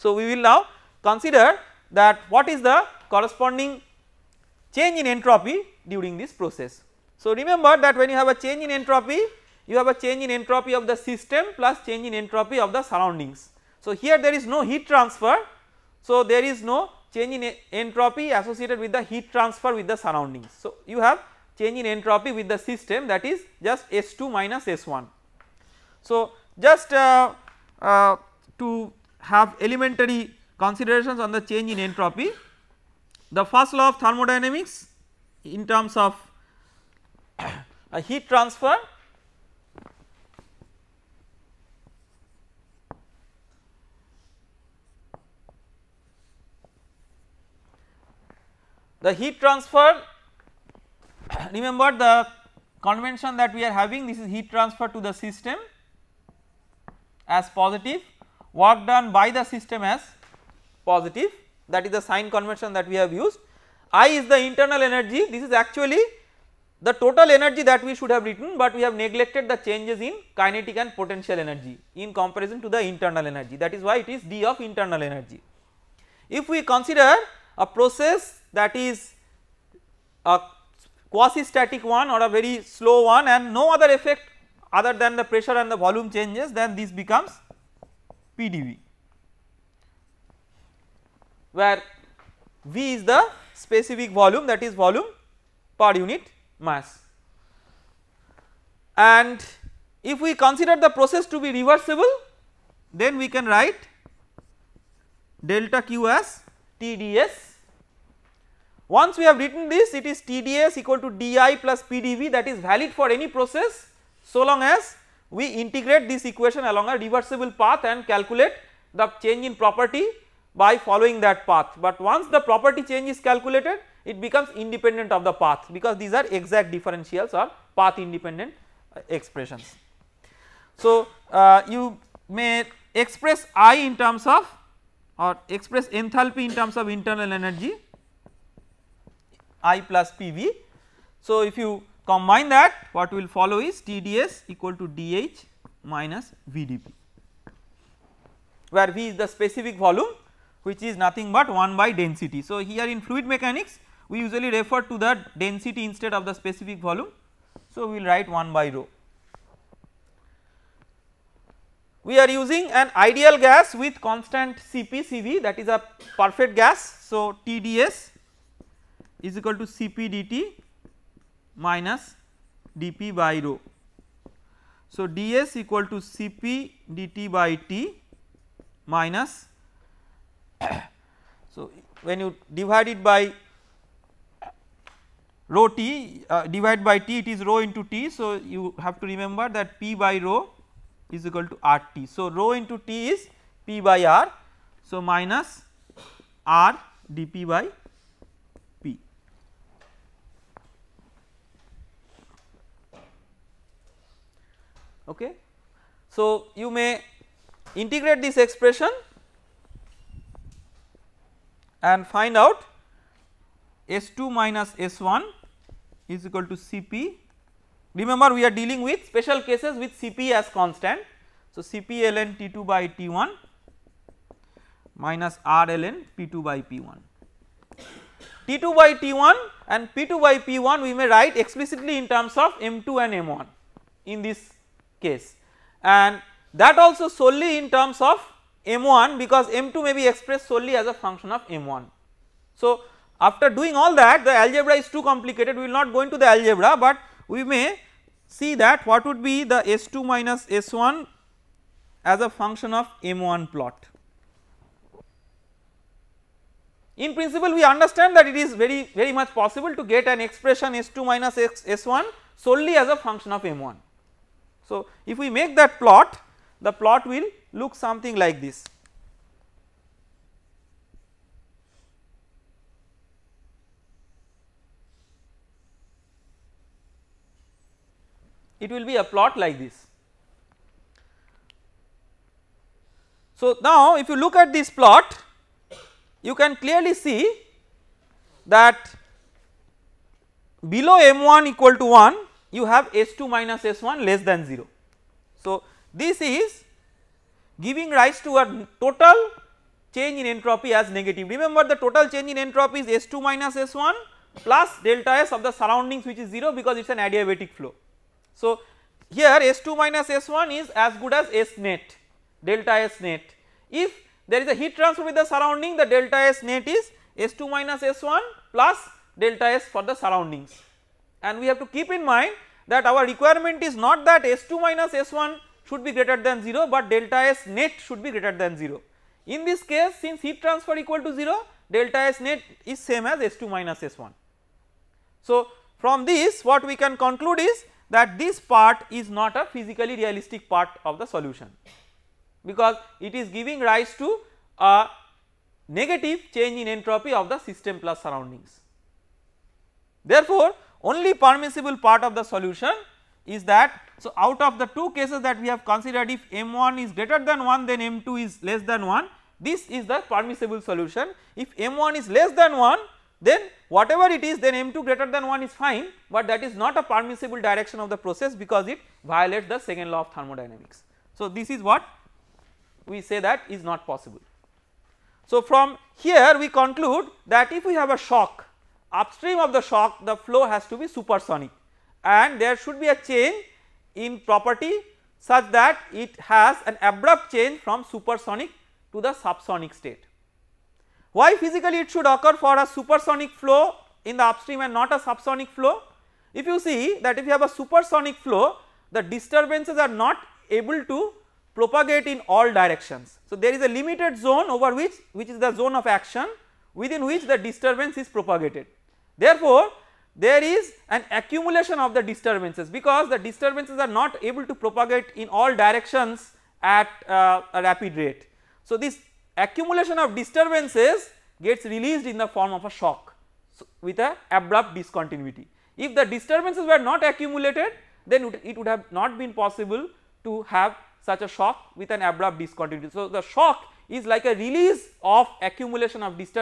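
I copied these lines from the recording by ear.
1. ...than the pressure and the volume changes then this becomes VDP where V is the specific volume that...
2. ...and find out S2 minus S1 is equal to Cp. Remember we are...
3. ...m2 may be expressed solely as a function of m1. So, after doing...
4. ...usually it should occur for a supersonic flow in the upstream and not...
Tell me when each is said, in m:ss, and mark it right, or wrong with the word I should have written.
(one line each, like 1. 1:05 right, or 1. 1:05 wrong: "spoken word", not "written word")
1. 1:24 wrong: "PDV", not "VDP"
2. 3:31 right
3. 3:59 right
4. 6:31 wrong: "physically", not "usually".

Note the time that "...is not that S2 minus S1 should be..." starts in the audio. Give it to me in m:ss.
5:23.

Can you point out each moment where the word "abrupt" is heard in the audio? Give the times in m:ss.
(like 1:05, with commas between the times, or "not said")
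6:26, 7:04, 7:12.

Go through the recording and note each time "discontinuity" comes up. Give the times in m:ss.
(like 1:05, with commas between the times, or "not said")
7:04, 7:12.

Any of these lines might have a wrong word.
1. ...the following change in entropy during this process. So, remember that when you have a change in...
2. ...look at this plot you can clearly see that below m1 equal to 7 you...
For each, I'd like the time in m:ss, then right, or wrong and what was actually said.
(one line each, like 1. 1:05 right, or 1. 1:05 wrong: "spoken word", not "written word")
1. 0:02 wrong: "corresponding", not "following"
2. 4:44 wrong: "1", not "7".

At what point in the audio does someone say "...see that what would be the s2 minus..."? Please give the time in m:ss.
4:08.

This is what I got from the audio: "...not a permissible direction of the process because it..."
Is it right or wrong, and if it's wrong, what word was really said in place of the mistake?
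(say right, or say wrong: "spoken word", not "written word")
right.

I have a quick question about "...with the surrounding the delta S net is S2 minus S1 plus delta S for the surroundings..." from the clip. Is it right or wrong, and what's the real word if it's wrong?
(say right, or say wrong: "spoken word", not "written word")
right.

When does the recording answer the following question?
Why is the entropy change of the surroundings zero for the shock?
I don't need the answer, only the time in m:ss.
5:06.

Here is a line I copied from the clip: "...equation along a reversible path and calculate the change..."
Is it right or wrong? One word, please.
right.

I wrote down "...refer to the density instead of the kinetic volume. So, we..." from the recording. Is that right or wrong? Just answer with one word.
wrong.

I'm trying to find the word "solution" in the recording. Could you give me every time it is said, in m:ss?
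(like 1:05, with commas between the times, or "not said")
5:41, 5:52, 6:00.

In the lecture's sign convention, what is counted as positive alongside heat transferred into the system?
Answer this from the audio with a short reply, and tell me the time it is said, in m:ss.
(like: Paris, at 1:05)
Work done by the system, at 0:58.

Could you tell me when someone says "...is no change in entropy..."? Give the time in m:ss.
0:16.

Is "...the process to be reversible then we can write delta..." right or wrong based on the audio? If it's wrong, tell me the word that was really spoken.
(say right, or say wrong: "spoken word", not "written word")
right.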